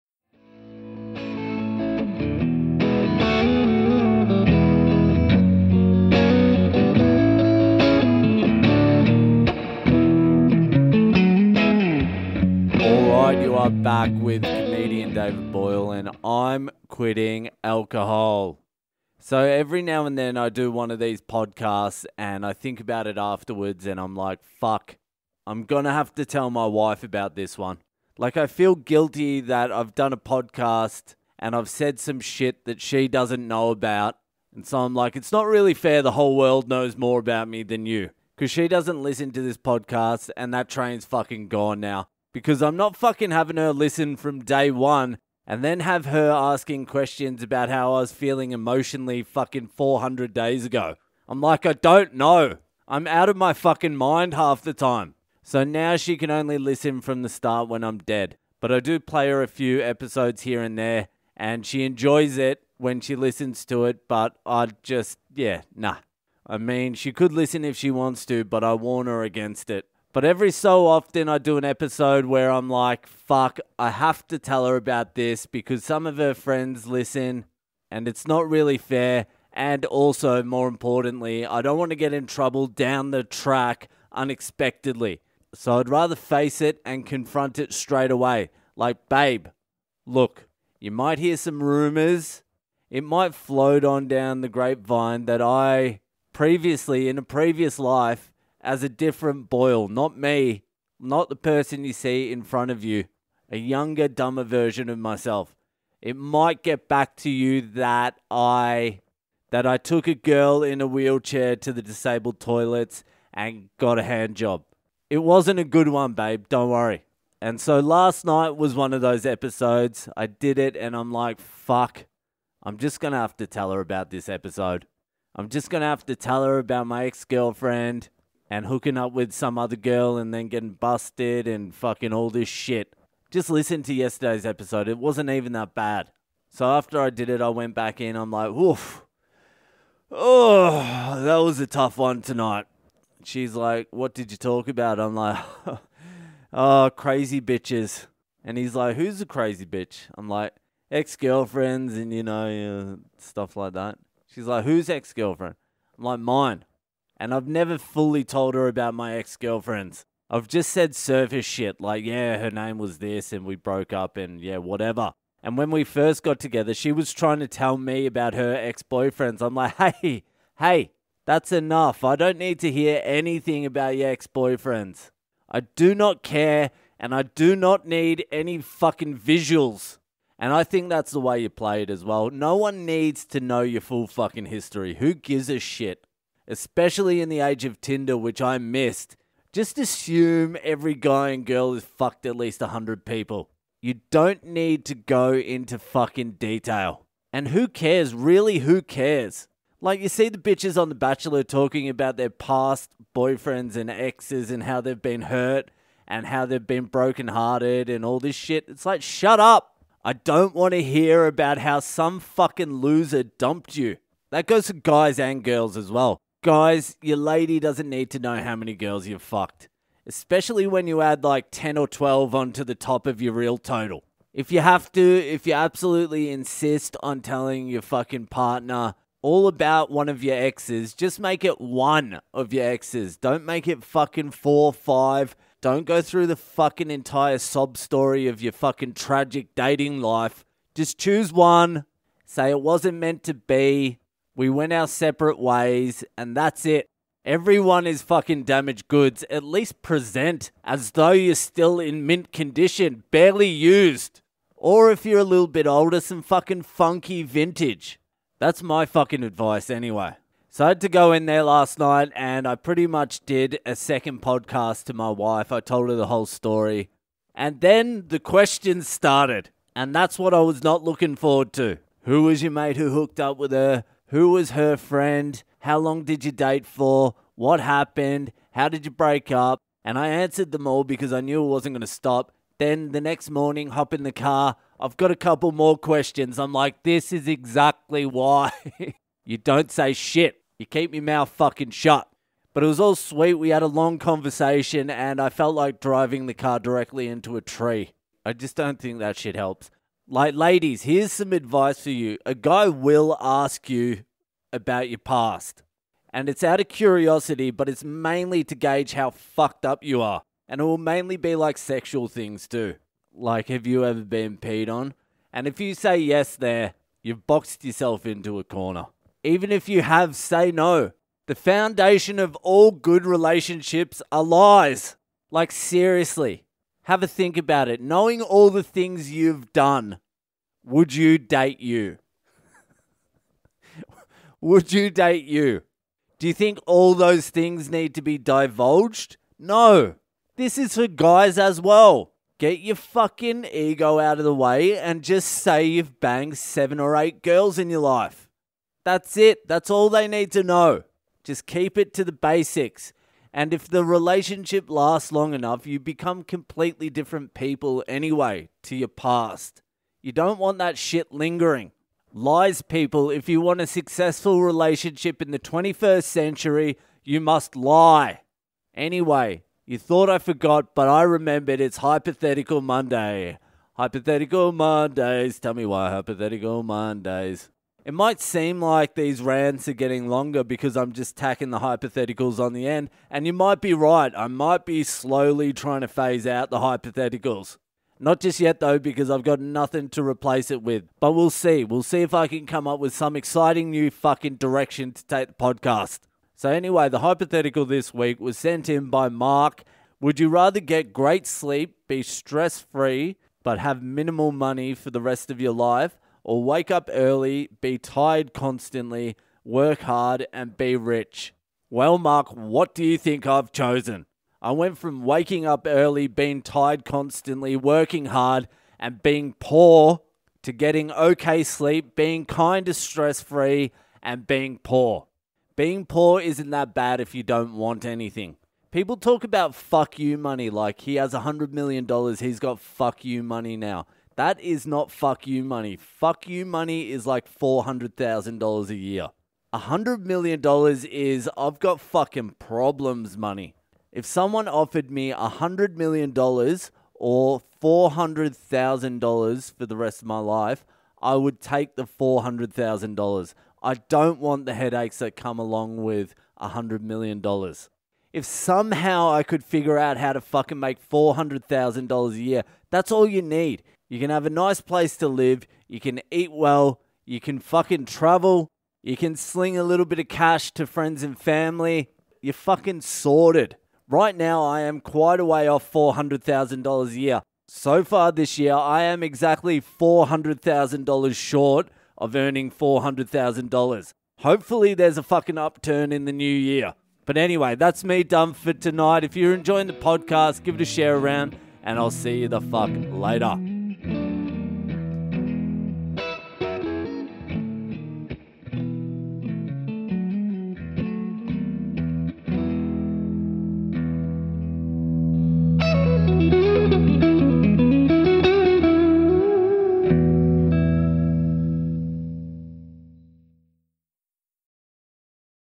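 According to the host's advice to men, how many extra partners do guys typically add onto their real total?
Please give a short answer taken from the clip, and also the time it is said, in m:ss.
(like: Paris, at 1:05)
10 or 12, at 3:41.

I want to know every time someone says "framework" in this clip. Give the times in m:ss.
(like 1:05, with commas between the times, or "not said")
not said.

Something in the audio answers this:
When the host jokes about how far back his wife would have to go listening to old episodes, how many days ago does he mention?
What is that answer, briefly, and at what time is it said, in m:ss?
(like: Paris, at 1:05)
400, at 0:49.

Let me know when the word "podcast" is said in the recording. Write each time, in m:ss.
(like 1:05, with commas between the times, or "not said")
0:21, 0:30, 0:39, 4:24, 6:35, 8:09.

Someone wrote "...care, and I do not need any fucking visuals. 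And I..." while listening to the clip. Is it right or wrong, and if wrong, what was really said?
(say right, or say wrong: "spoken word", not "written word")
right.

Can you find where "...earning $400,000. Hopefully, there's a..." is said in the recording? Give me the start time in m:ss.
8:02.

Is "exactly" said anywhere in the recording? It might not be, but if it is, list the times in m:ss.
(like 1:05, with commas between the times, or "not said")
4:47, 7:59.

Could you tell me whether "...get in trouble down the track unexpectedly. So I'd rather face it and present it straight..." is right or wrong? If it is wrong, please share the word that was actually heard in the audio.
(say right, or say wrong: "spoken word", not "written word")
wrong: "confront", not "present".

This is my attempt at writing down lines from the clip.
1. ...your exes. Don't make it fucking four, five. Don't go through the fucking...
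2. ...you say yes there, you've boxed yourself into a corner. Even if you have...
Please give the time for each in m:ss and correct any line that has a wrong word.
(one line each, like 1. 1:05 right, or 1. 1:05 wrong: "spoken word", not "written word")
1. 3:52 right
2. 5:15 right.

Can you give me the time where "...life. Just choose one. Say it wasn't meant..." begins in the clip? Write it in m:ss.
4:00.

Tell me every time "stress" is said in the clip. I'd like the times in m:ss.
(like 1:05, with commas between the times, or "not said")
6:42, 7:02.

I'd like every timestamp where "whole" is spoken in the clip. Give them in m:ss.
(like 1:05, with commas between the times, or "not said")
0:36, 4:26.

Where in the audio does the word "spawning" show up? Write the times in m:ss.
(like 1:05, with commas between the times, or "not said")
not said.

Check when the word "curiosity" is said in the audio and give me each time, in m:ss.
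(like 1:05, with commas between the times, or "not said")
5:06.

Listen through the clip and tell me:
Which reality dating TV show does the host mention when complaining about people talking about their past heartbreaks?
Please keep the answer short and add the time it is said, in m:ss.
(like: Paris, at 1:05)
The Bachelor, at 3:20.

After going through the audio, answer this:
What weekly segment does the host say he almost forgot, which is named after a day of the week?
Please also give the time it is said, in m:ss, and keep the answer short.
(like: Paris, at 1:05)
Hypothetical Monday, at 6:11.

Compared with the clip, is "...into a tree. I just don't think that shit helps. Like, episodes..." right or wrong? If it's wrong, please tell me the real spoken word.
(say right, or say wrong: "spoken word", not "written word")
wrong: "ladies", not "episodes".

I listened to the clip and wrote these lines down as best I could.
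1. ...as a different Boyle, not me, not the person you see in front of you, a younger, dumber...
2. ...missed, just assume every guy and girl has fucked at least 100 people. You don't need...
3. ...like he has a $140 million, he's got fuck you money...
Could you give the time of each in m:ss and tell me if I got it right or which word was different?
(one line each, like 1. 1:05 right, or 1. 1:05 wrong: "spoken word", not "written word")
1. 1:38 right
2. 3:08 right
3. 7:10 wrong: "100", not "140".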